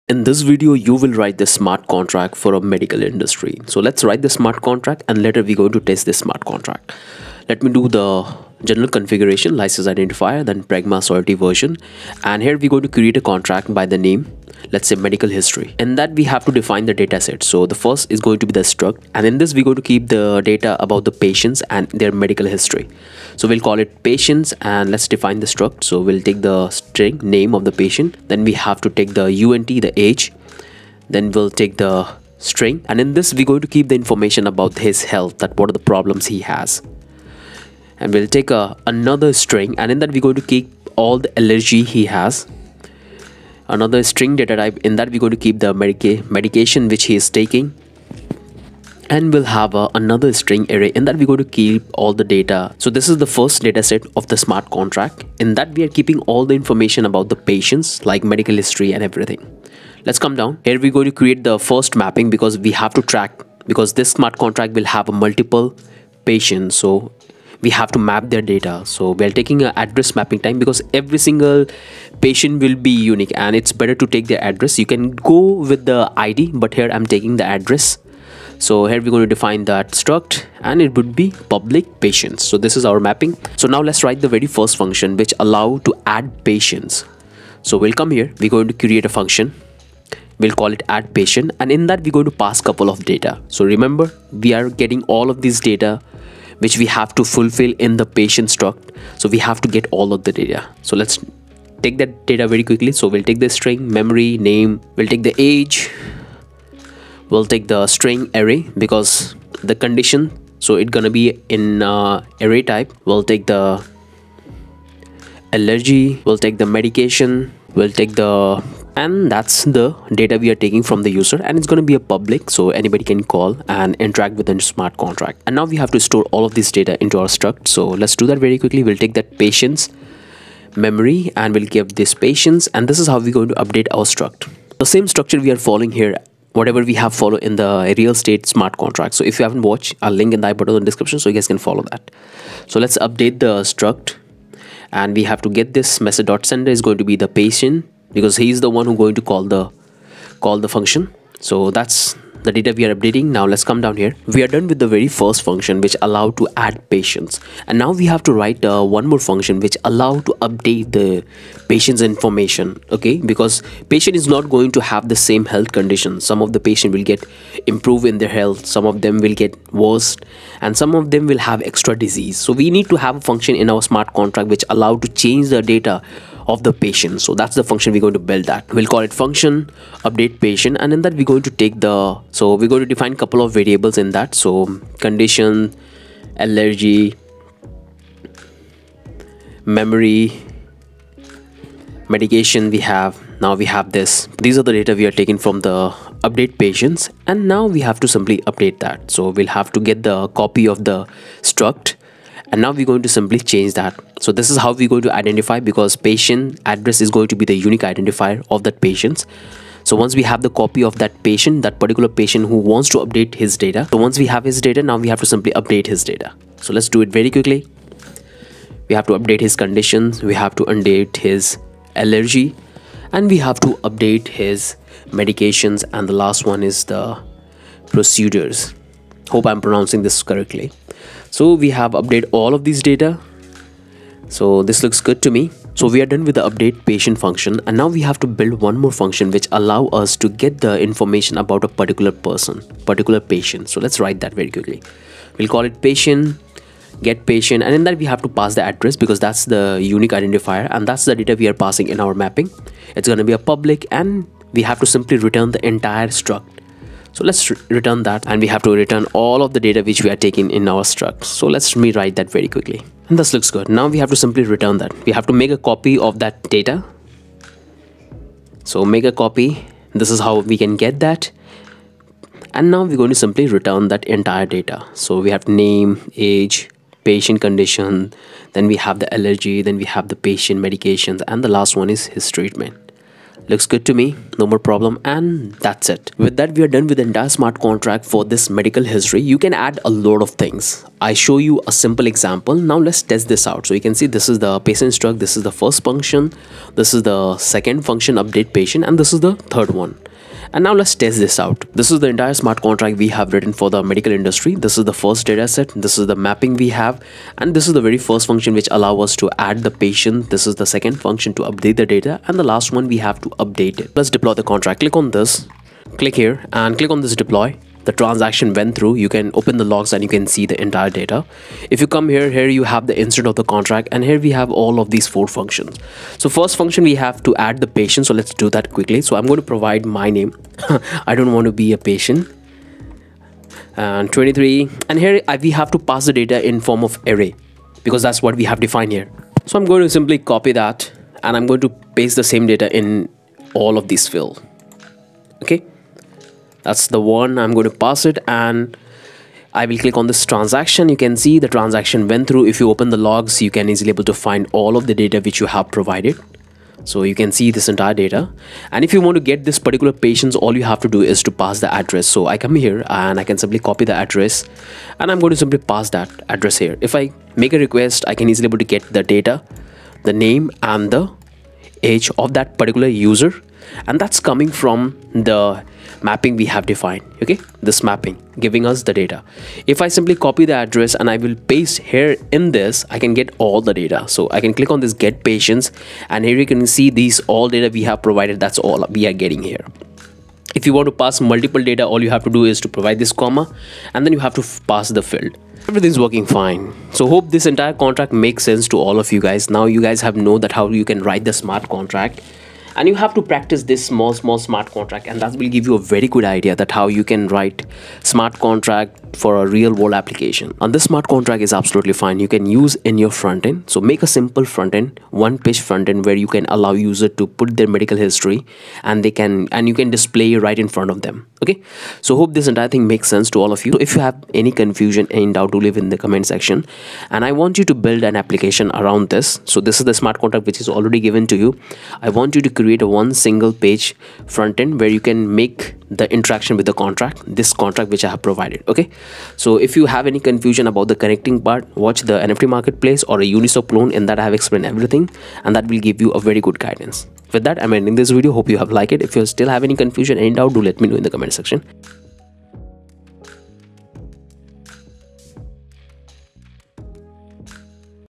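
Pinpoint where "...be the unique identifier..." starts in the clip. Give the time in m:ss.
3:27.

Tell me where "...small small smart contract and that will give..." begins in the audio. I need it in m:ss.
6:43.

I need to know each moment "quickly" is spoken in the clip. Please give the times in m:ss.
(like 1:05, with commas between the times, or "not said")
1:42, 2:08, 3:37, 4:04, 4:22, 5:28.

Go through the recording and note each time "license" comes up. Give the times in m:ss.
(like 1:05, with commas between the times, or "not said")
0:09.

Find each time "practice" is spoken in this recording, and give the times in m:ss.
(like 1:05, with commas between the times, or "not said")
6:43.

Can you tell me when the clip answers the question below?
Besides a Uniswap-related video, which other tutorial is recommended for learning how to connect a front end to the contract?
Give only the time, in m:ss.
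7:22.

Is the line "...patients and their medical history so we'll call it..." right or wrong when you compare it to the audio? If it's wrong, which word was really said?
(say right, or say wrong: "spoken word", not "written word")
right.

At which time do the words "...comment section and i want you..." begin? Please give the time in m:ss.
7:05.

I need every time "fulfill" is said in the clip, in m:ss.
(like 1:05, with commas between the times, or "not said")
1:37.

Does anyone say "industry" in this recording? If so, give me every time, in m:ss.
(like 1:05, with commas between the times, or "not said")
0:03, 5:04.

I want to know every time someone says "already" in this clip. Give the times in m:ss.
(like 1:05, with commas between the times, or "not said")
7:10.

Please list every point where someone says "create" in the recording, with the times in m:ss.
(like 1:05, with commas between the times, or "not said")
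0:12, 1:01, 1:28, 7:12.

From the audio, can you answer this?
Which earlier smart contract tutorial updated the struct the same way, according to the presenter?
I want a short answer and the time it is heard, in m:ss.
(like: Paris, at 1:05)
Real estate, at 2:17.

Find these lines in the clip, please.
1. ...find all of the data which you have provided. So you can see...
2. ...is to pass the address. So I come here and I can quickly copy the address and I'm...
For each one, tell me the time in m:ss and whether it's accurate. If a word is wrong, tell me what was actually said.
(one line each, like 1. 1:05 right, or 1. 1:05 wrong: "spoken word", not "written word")
1. 5:54 right
2. 6:01 wrong: "simply", not "quickly".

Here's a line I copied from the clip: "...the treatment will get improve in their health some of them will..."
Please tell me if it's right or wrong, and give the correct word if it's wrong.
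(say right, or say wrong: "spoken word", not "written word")
wrong: "patient", not "treatment".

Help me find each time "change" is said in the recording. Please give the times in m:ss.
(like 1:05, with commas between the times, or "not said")
2:55, 3:23.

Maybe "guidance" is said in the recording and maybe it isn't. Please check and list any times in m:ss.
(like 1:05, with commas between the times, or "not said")
7:26.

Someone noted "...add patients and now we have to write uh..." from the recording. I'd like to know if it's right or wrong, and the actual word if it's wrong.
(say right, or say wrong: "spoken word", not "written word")
right.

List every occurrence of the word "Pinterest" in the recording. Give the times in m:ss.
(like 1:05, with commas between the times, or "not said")
not said.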